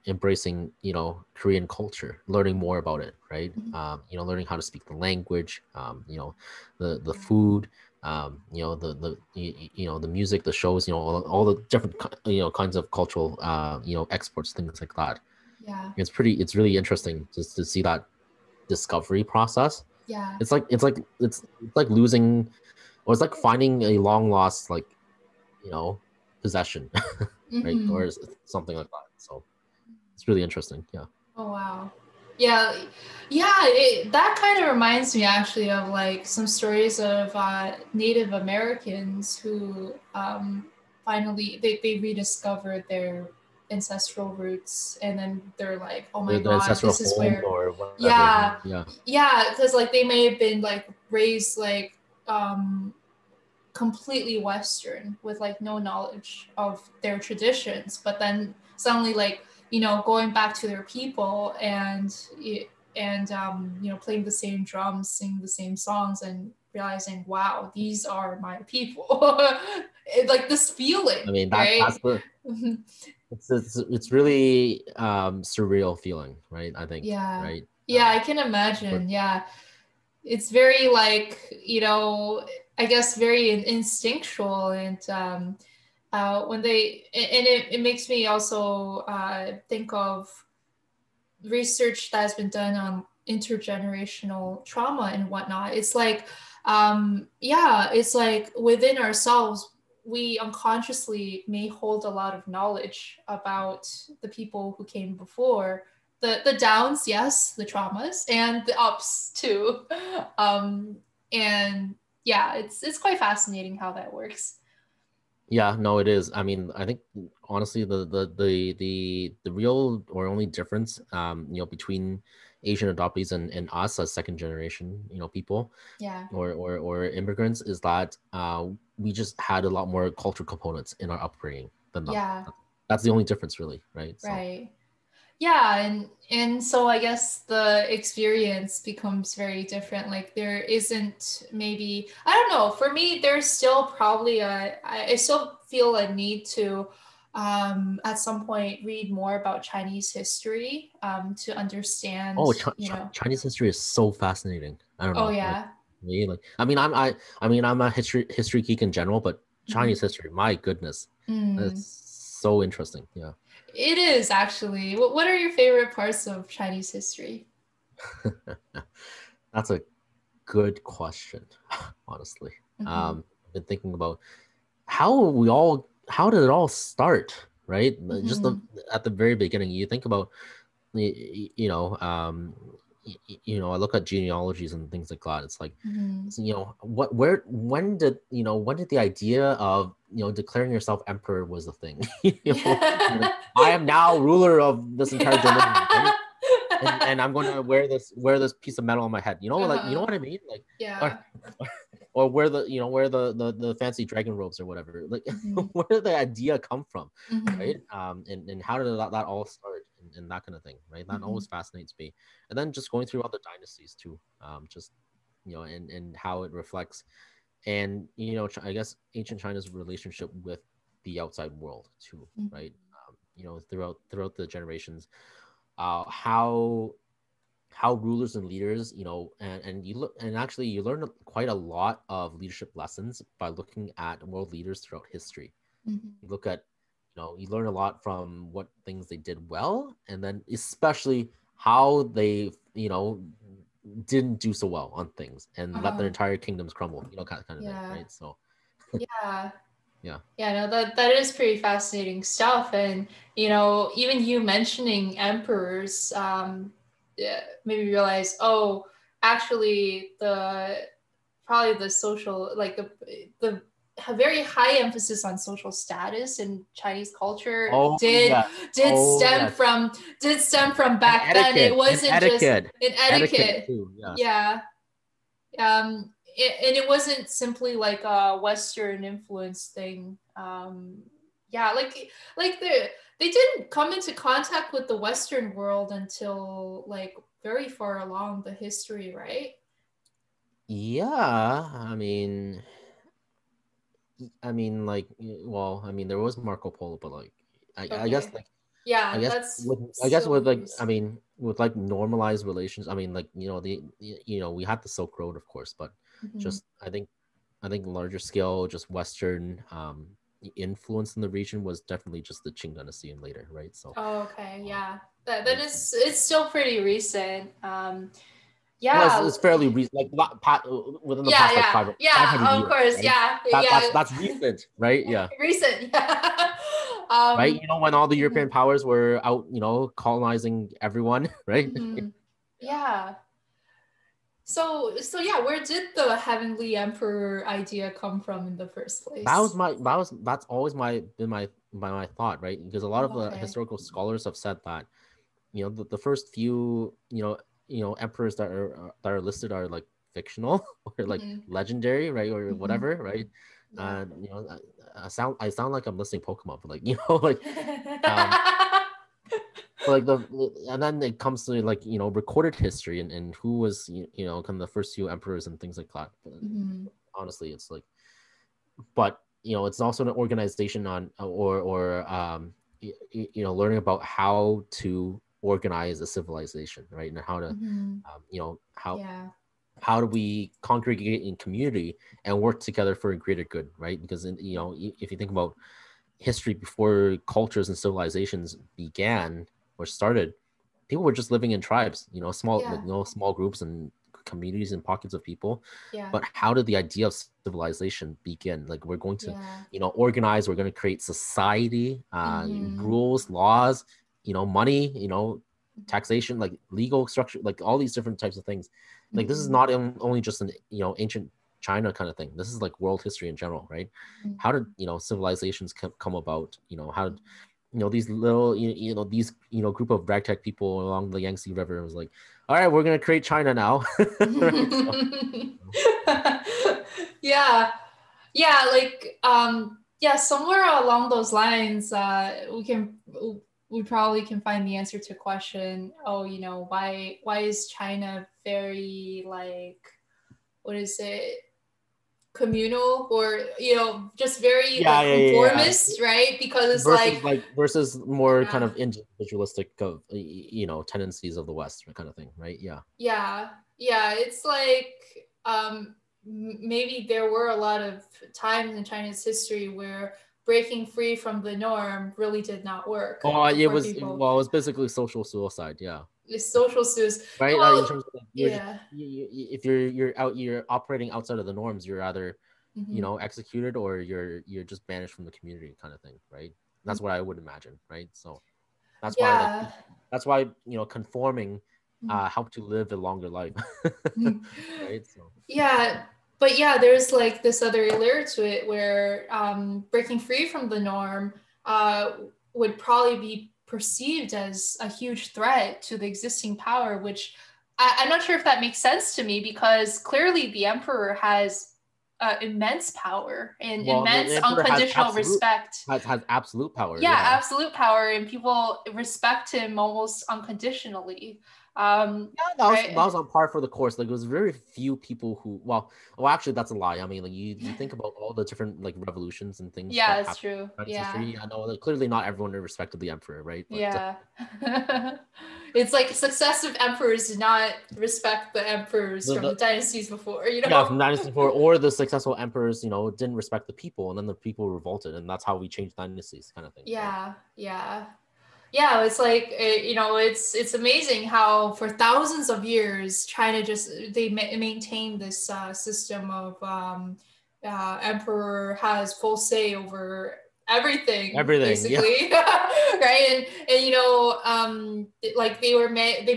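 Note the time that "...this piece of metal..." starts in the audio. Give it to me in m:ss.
3:18.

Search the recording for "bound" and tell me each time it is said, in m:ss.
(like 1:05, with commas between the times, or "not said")
not said.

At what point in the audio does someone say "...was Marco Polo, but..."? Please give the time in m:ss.
4:56.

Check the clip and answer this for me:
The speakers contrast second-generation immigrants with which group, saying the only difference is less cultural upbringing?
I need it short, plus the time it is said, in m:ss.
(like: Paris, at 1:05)
Asian adoptees, at 2:02.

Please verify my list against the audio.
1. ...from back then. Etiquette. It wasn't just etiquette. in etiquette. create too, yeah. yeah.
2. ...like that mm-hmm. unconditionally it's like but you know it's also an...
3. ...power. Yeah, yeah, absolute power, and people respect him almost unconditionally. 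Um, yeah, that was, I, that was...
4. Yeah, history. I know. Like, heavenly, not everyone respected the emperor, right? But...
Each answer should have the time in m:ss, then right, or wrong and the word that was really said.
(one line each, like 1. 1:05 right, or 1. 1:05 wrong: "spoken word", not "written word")
1. 4:30 wrong: "etiquette", not "create"
2. 6:05 wrong: "honestly", not "unconditionally"
3. 8:26 right
4. 8:40 wrong: "clearly", not "heavenly".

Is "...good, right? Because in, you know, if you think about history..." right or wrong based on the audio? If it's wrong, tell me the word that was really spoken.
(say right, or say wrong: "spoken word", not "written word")
right.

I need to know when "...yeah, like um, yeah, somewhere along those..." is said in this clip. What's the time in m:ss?
7:08.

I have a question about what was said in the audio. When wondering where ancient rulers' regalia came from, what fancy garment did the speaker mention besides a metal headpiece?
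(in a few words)
dragon robes.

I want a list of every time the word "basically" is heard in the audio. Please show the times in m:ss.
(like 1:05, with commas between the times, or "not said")
7:44, 9:11.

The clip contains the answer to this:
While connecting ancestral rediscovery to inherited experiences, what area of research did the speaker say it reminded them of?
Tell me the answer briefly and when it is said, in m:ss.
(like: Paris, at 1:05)
intergenerational trauma, at 1:33.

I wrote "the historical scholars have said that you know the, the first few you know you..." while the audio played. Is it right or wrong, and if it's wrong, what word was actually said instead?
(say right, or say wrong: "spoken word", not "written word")
right.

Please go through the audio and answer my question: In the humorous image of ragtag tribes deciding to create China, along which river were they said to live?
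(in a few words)
Yangtze River.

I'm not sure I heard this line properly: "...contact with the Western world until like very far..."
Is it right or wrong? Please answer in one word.
right.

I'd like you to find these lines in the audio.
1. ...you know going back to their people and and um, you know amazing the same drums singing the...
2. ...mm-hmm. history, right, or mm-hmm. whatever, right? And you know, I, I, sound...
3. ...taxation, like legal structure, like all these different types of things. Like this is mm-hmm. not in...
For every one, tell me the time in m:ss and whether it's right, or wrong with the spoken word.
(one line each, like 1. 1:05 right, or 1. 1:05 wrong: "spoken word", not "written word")
1. 0:59 wrong: "playing", not "amazing"
2. 5:51 wrong: "legendary", not "history"
3. 6:45 right.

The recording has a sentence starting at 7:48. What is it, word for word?
you, you, if you're you're out, you're operating outside of the norms.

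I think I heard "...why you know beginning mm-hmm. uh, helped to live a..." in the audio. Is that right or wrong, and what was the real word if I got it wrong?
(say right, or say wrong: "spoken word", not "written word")
wrong: "conforming", not "beginning".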